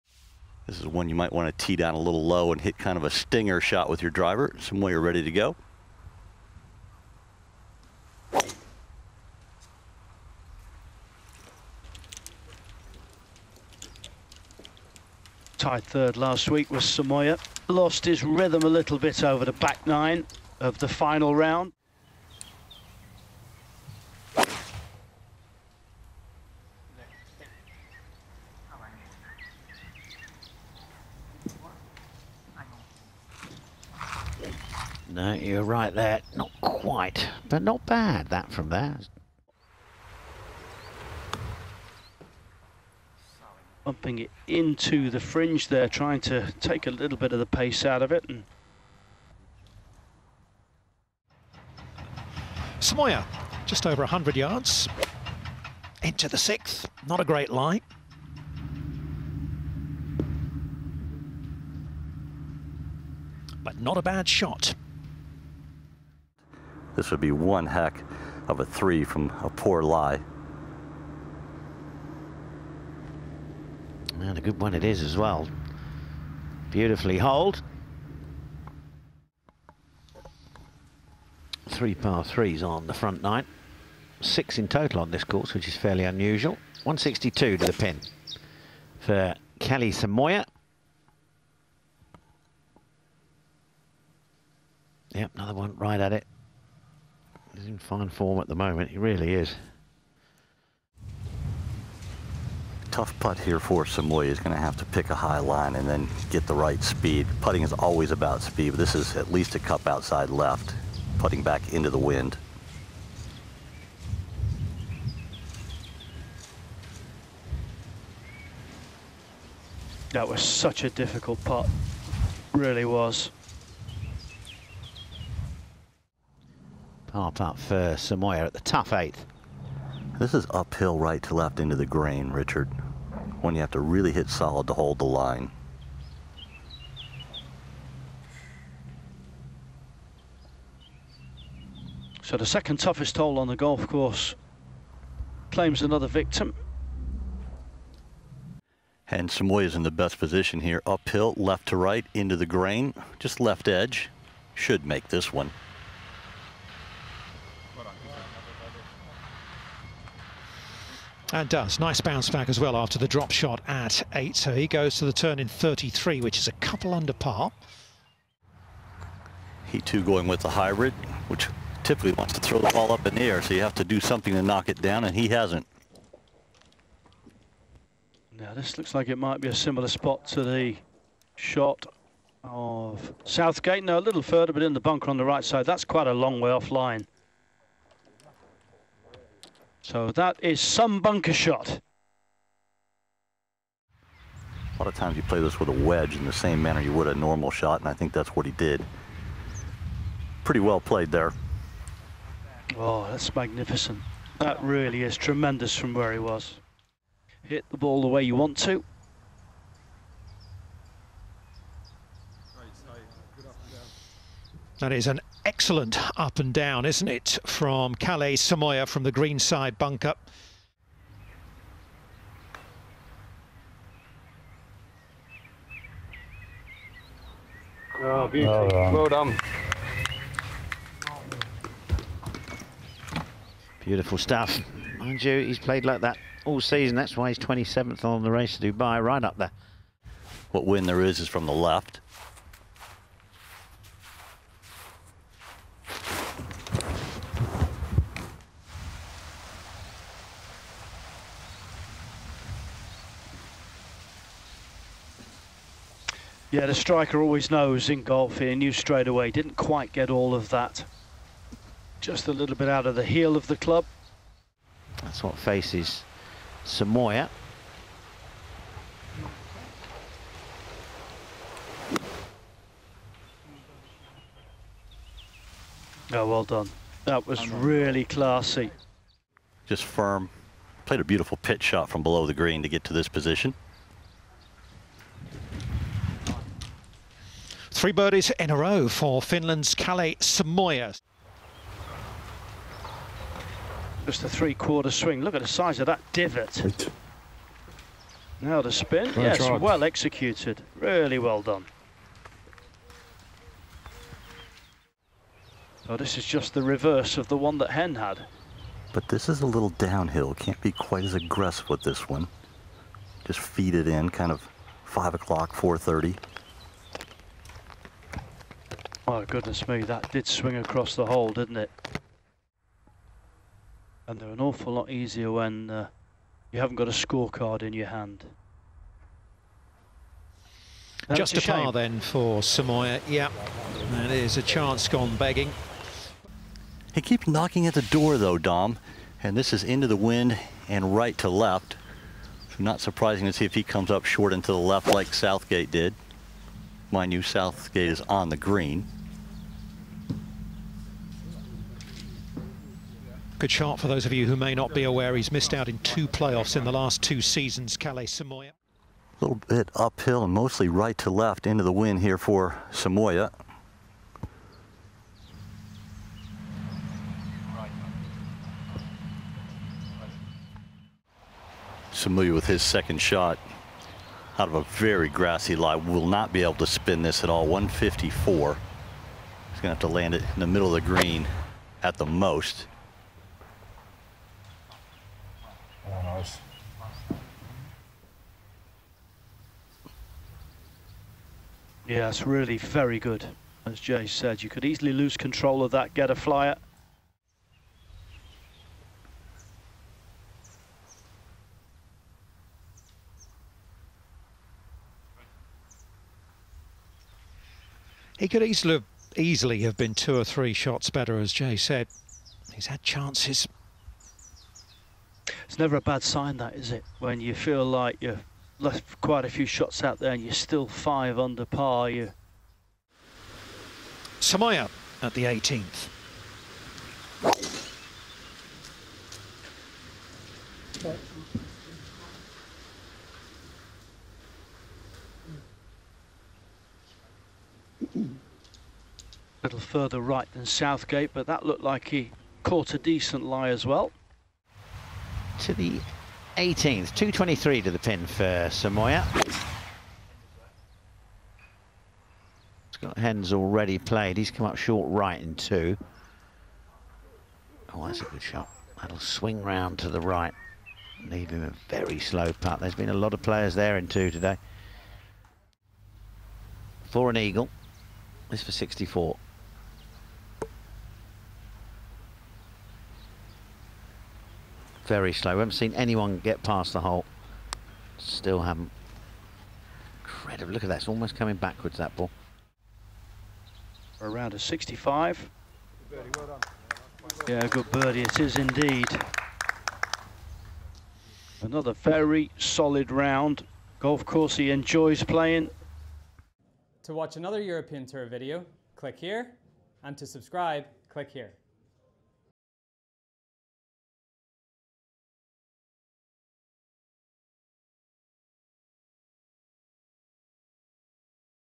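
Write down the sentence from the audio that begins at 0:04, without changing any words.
Some way you're ready to go.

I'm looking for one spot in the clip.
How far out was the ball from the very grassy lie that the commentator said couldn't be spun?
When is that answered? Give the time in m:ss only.
6:17.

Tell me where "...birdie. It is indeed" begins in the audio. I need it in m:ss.
8:07.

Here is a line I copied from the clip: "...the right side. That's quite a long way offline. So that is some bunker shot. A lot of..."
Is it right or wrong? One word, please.
right.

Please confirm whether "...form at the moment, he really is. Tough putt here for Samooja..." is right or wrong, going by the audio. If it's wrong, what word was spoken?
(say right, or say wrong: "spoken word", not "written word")
right.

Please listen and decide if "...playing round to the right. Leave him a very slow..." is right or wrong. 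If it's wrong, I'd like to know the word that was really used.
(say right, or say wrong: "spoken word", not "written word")
wrong: "swing", not "playing".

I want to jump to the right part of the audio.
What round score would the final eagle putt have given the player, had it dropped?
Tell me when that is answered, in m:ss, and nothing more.
7:48.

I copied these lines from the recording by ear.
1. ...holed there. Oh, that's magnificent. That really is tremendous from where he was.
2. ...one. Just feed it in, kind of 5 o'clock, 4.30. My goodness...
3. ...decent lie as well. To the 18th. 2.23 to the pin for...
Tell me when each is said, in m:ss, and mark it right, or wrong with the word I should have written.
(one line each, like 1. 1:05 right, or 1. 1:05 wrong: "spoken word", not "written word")
1. 3:20 wrong: "played", not "holed"
2. 5:12 right
3. 7:22 right.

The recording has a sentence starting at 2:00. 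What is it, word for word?
That was such a difficult putt, really was.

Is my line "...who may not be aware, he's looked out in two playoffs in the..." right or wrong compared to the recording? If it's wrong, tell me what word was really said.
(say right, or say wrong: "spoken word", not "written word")
wrong: "missed", not "looked".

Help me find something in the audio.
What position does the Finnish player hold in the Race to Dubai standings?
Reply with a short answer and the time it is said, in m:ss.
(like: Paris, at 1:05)
27th, at 3:57.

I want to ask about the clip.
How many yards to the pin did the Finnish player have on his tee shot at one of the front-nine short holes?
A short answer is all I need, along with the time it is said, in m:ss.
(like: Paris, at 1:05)
162, at 1:26.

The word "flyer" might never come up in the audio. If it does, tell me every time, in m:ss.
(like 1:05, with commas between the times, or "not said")
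6:36.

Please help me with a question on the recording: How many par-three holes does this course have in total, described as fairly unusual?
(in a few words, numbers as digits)
6.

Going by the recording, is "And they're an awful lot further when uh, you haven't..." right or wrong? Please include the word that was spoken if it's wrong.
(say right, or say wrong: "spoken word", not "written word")
wrong: "easier", not "further".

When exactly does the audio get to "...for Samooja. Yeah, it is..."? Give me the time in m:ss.
5:31.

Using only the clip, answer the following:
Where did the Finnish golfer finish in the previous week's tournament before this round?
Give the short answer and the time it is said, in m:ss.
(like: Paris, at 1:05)
Tied third, at 0:15.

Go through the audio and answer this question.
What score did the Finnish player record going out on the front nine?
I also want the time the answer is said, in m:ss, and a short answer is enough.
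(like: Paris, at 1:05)
33, at 2:45.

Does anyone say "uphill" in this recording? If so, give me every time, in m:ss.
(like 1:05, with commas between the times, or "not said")
2:10, 2:30, 5:59.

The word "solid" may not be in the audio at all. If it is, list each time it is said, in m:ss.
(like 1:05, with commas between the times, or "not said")
2:14, 8:12.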